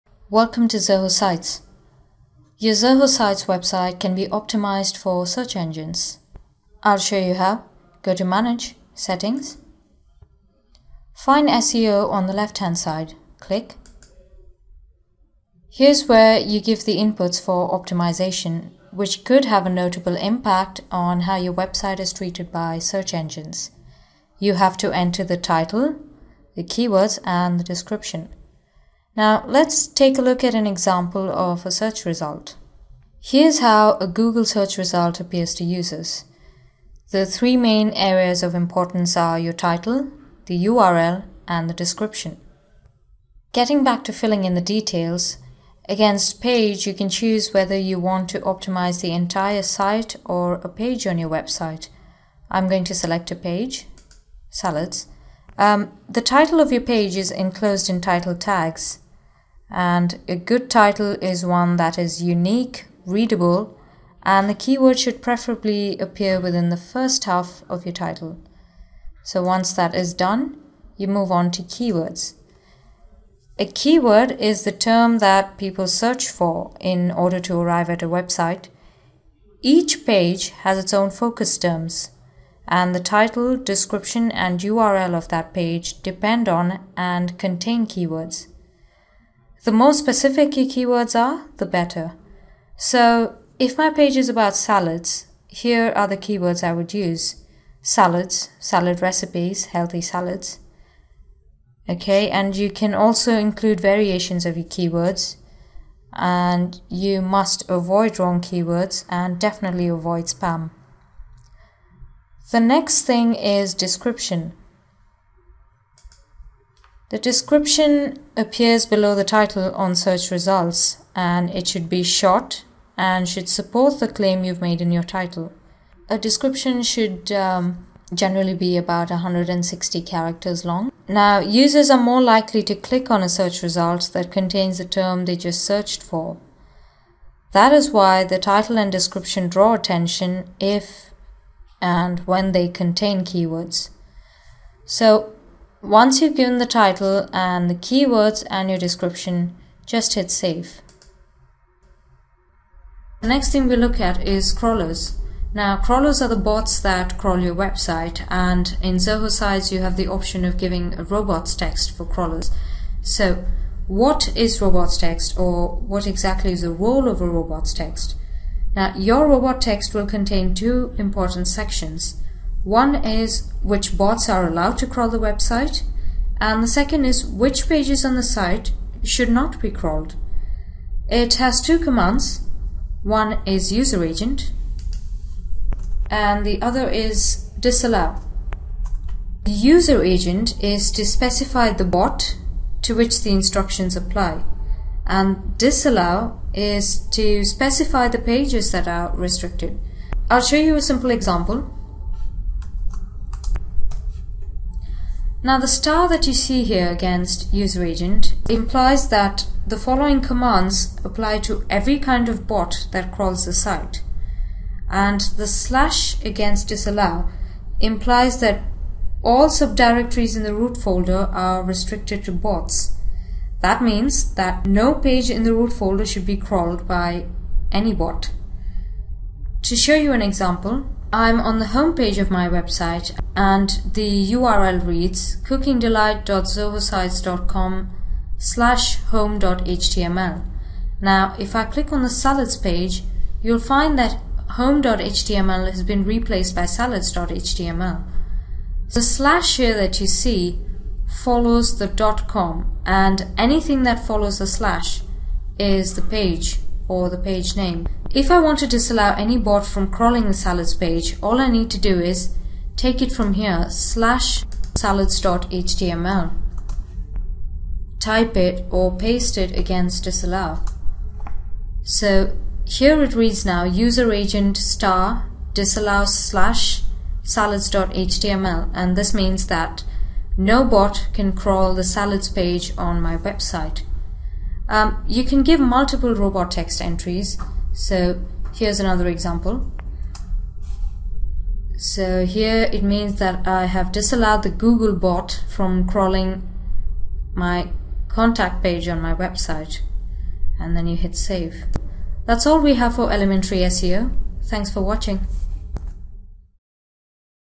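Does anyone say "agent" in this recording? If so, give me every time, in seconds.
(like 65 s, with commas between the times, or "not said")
184 s, 190 s, 207 s, 274 s.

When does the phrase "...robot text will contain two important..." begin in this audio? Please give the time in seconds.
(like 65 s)
169 s.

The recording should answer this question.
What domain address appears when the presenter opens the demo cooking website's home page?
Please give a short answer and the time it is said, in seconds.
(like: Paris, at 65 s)
cookingdelight.zohosites.com, at 235 s.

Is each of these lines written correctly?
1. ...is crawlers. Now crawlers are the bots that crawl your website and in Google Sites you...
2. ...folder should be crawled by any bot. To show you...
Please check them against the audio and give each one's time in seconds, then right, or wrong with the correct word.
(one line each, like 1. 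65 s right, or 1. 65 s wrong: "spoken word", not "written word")
1. 154 s wrong: "Zoho", not "Google"
2. 225 s right.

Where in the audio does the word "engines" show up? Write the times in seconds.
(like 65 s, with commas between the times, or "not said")
5 s, 23 s.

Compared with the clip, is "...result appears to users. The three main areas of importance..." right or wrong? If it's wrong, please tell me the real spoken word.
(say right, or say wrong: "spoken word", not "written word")
right.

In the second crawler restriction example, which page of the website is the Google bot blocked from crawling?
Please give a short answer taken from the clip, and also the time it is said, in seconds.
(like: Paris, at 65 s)
contact page, at 298 s.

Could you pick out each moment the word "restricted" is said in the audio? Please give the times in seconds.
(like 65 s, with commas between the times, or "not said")
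199 s, 221 s.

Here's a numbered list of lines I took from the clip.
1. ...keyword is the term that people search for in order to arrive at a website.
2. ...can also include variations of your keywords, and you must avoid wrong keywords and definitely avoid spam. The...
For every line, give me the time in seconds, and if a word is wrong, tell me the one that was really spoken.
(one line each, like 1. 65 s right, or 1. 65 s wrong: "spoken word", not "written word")
1. 73 s right
2. 102 s right.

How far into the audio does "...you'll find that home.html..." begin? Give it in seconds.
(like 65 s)
243 s.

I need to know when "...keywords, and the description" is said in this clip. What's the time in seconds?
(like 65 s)
26 s.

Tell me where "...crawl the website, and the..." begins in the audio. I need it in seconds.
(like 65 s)
174 s.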